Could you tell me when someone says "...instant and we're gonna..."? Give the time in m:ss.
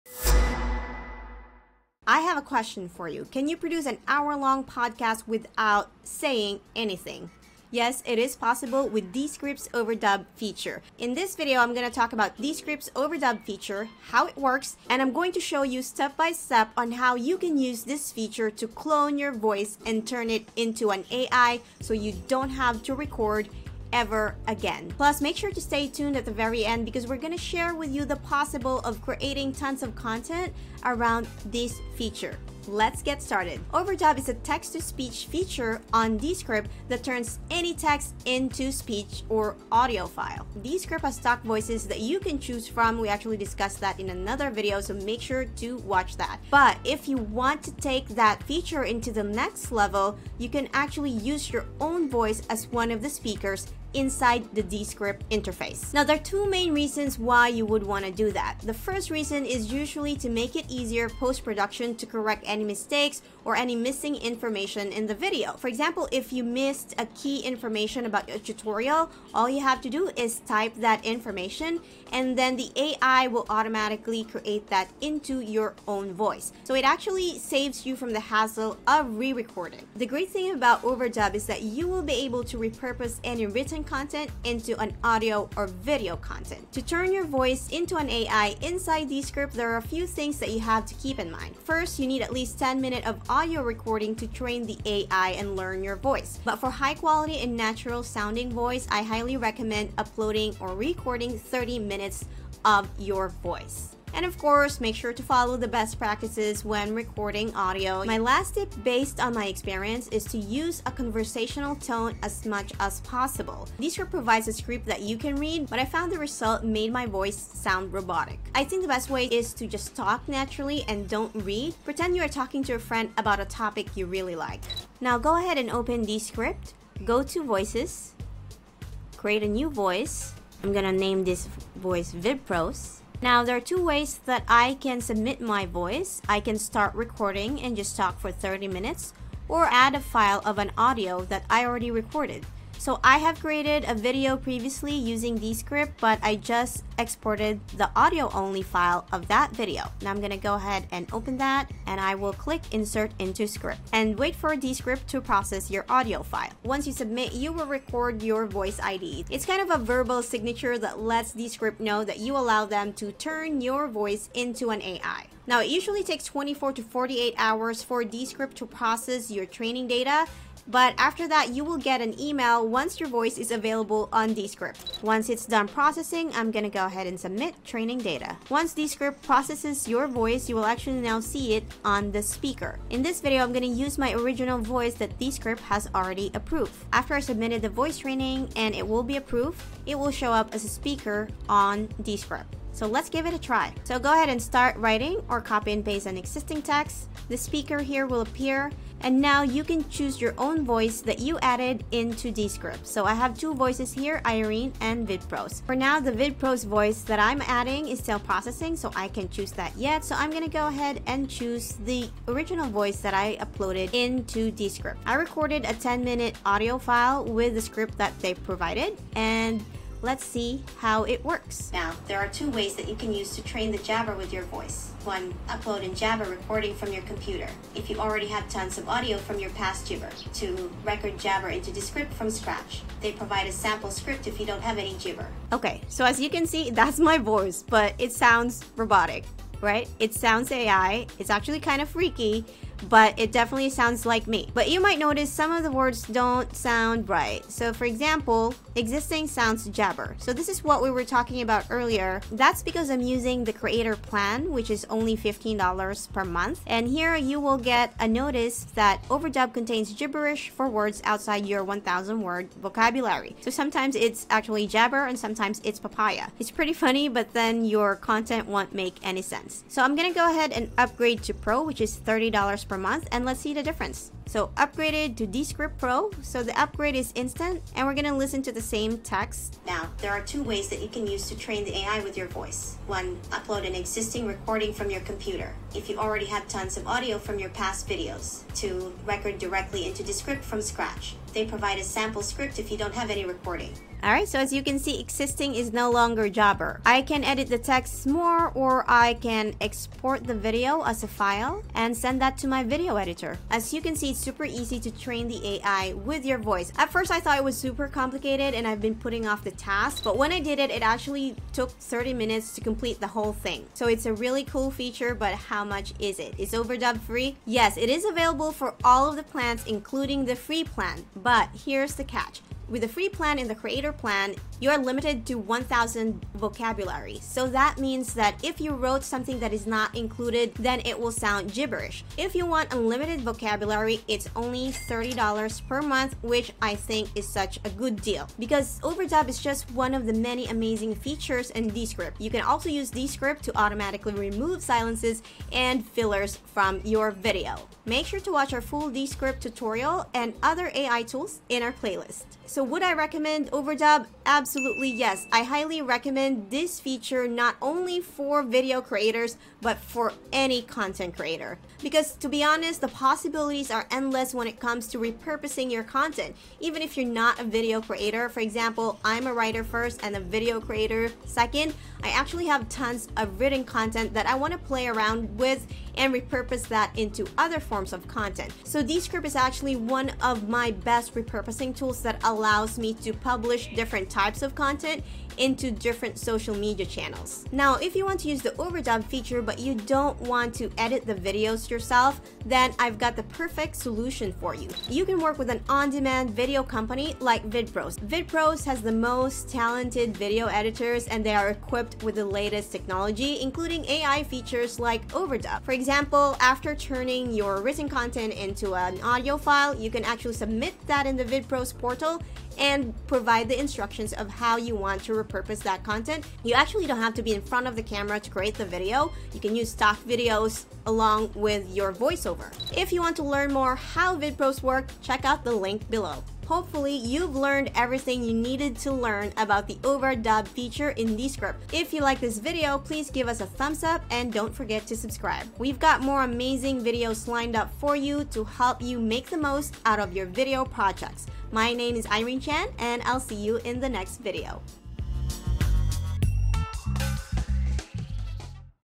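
4:37.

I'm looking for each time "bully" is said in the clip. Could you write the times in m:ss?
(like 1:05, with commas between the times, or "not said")
not said.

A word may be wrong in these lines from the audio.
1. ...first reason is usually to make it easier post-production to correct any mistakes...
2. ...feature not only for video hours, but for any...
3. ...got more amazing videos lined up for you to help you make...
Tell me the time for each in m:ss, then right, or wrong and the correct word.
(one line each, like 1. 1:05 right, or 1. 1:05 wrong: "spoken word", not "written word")
1. 0:58 right
2. 5:56 wrong: "creators", not "hours"
3. 7:15 right.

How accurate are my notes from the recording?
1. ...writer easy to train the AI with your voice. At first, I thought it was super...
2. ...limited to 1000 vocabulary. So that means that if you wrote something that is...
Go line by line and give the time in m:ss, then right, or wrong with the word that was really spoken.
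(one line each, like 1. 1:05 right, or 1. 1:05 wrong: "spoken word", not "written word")
1. 5:04 wrong: "super", not "writer"
2. 5:24 right.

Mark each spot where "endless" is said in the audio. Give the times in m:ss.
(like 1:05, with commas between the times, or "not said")
6:03.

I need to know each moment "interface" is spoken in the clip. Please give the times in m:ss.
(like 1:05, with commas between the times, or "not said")
0:55.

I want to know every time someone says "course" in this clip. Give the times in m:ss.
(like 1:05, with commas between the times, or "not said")
1:44.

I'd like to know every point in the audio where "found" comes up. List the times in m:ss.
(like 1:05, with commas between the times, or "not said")
1:55.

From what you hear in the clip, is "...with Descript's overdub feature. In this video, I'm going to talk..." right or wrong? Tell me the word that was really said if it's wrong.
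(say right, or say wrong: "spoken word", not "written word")
right.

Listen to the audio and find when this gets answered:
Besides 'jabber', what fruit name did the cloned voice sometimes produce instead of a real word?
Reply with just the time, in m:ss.
4:25.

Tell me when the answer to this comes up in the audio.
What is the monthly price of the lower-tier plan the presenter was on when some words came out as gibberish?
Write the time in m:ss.
4:15.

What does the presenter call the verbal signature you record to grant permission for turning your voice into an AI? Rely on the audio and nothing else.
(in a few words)
voice ID.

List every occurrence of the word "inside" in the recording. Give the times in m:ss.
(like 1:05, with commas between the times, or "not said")
0:53, 1:28.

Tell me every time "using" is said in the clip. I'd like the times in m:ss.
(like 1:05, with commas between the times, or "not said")
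2:24, 4:13.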